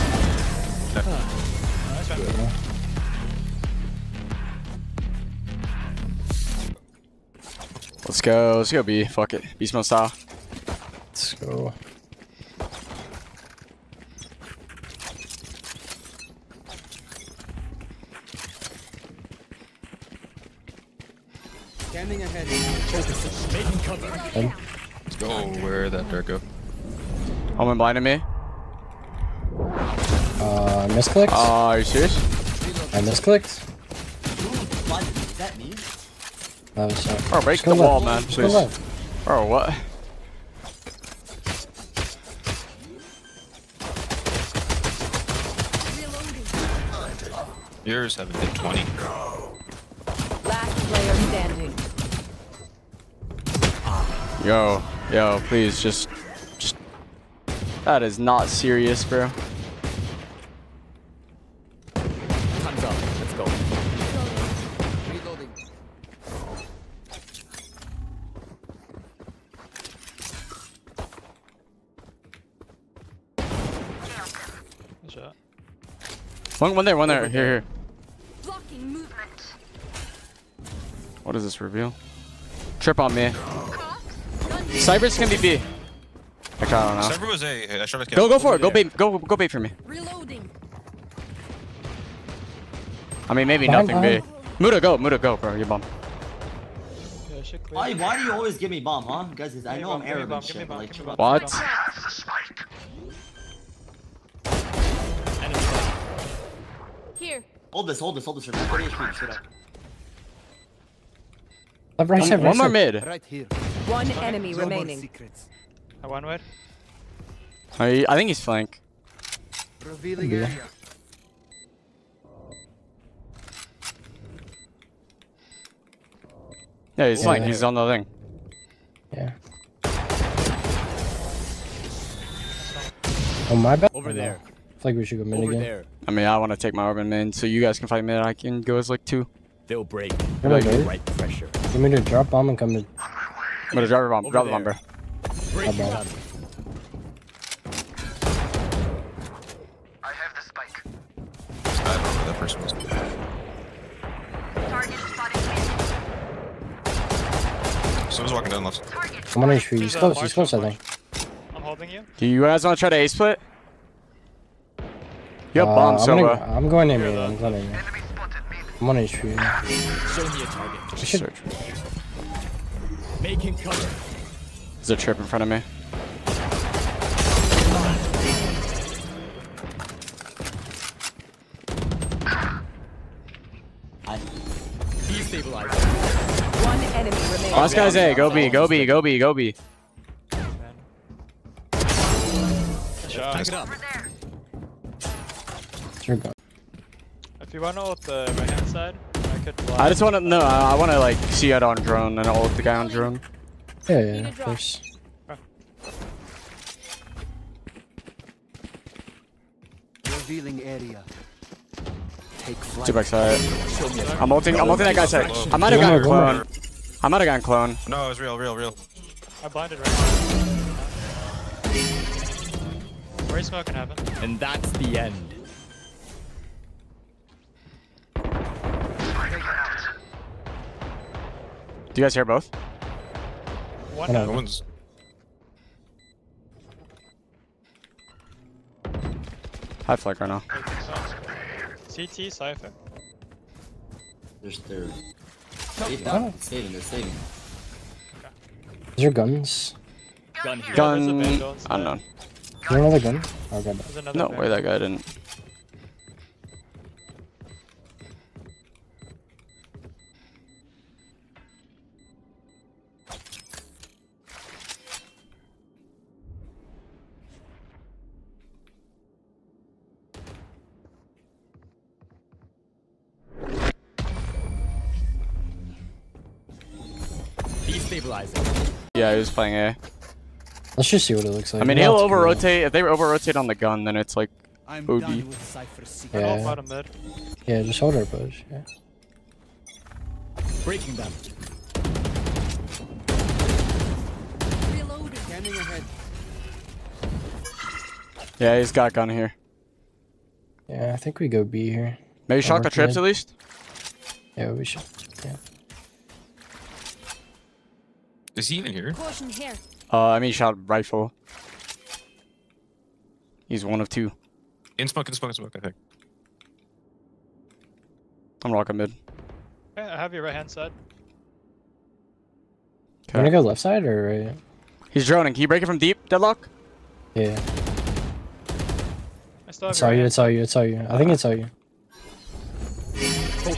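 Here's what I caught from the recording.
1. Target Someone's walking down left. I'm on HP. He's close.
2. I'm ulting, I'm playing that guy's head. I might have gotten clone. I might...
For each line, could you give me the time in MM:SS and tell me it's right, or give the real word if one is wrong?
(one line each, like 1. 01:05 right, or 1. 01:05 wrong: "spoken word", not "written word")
1. 02:34 right
2. 03:34 wrong: "ulting", not "playing".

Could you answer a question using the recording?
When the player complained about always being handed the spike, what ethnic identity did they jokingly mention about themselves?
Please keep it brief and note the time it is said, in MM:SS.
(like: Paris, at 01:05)
Arab, at 01:40.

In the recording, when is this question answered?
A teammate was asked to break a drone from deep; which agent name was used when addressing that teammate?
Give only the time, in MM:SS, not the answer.
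05:26.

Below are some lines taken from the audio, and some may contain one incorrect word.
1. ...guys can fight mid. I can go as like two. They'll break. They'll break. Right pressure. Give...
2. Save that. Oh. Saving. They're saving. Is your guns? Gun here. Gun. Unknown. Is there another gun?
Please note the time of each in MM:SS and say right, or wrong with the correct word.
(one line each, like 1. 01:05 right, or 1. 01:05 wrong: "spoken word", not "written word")
1. 02:17 right
2. 04:05 right.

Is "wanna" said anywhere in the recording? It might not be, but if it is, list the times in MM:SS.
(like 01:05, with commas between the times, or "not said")
03:17, 05:23.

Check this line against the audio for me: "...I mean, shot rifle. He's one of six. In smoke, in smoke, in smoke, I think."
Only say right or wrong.
wrong.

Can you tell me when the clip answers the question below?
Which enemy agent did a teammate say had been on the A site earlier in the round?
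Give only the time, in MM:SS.
01:27.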